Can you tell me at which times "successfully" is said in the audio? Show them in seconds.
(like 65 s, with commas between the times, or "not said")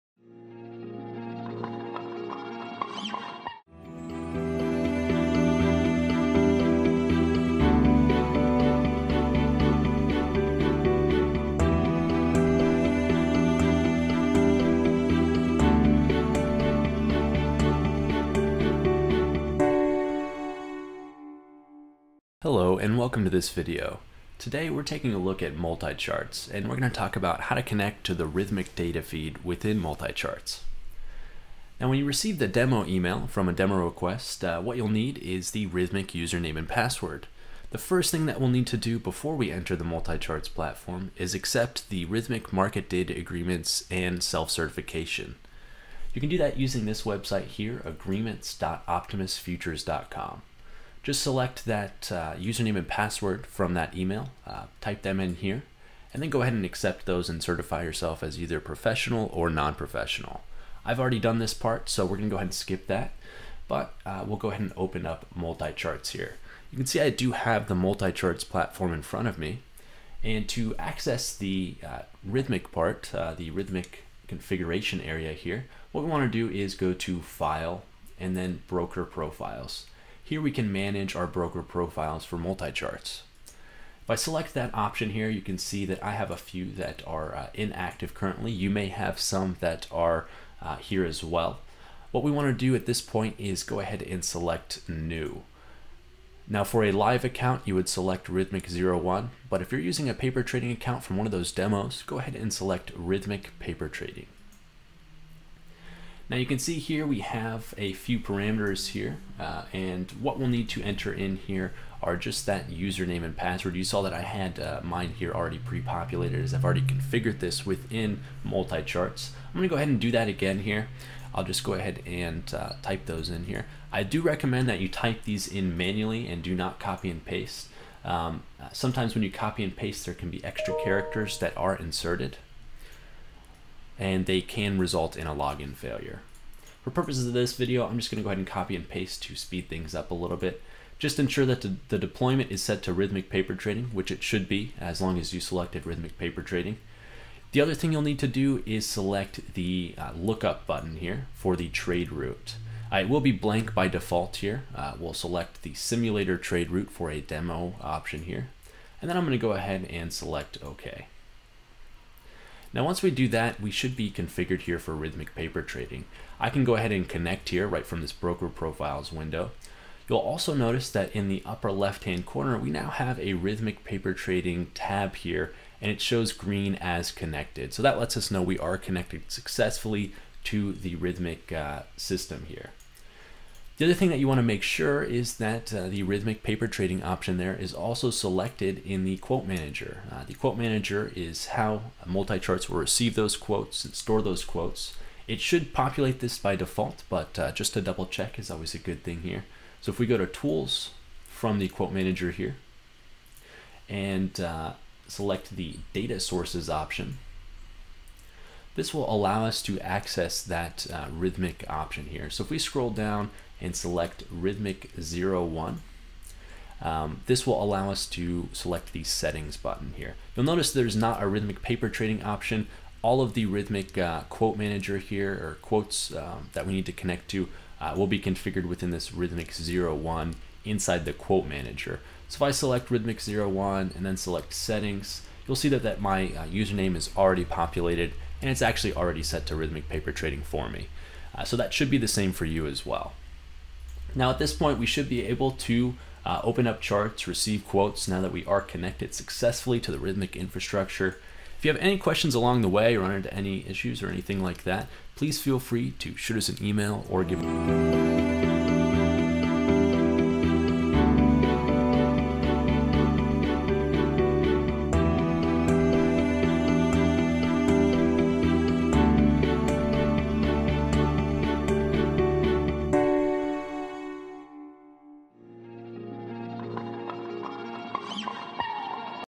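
179 s, 249 s.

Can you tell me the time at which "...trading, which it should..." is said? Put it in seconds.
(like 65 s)
143 s.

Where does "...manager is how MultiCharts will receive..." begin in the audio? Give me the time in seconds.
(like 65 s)
190 s.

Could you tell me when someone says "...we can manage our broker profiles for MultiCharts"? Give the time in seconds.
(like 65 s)
80 s.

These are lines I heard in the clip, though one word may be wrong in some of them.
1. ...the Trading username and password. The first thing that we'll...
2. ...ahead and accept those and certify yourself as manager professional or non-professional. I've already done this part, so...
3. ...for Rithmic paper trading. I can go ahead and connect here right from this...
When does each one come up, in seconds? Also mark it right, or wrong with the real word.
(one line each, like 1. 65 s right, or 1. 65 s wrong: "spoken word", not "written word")
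1. 35 s wrong: "Rithmic", not "Trading"
2. 56 s wrong: "either", not "manager"
3. 164 s right.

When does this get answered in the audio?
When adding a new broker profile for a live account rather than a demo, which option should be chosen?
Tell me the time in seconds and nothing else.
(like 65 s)
98 s.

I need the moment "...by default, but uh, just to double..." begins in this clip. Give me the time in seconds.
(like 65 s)
196 s.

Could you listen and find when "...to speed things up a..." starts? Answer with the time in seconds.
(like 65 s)
139 s.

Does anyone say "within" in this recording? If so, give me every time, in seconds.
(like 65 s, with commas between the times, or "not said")
29 s, 117 s, 228 s.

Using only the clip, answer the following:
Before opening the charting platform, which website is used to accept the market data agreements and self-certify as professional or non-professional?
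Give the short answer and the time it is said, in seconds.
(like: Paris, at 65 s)
agreements.optimusfutures.com, at 47 s.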